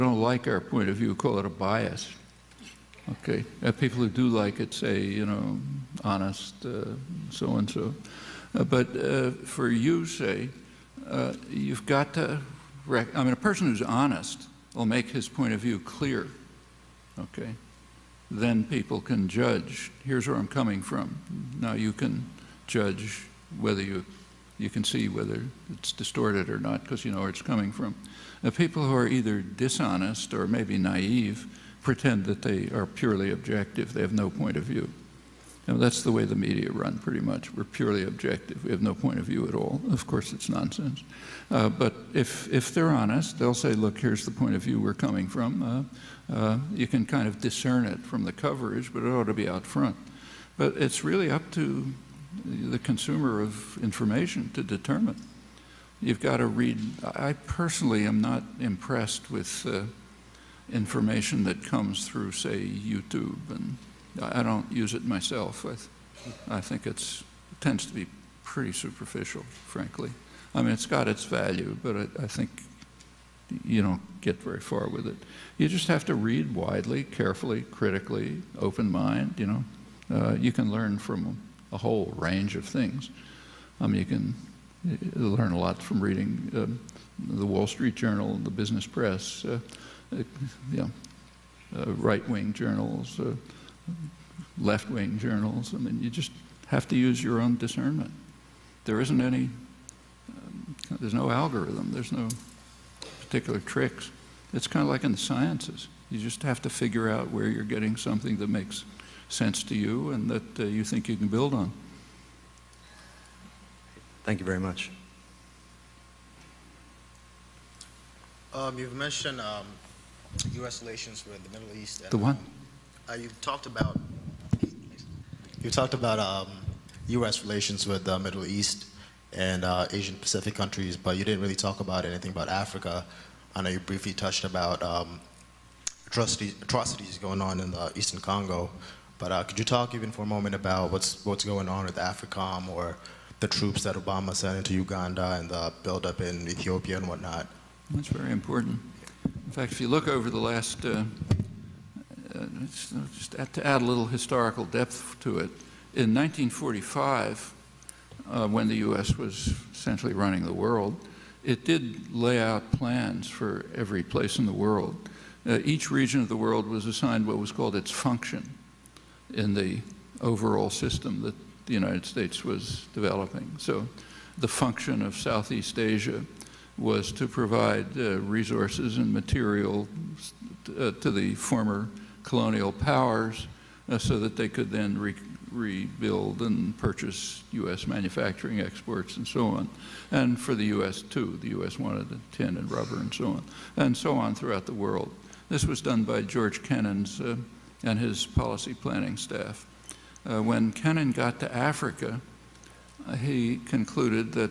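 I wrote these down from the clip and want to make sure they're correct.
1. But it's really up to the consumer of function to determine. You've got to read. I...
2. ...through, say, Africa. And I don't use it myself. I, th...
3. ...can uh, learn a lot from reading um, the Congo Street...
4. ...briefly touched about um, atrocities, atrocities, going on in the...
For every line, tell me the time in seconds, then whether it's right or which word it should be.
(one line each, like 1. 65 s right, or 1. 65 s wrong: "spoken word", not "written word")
1. 50 s wrong: "information", not "function"
2. 62 s wrong: "YouTube", not "Africa"
3. 84 s wrong: "Wall", not "Congo"
4. 133 s right.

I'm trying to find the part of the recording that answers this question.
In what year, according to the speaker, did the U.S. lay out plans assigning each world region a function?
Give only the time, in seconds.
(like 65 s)
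156 s.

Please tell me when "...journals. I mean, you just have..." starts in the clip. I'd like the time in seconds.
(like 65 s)
95 s.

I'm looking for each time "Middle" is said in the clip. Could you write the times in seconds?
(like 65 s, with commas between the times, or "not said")
121 s, 128 s.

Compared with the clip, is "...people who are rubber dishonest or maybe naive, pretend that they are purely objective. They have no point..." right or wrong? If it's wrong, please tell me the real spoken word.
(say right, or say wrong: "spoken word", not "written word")
wrong: "either", not "rubber".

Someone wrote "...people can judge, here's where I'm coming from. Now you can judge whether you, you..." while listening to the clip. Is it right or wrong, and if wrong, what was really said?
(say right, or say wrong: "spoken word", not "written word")
right.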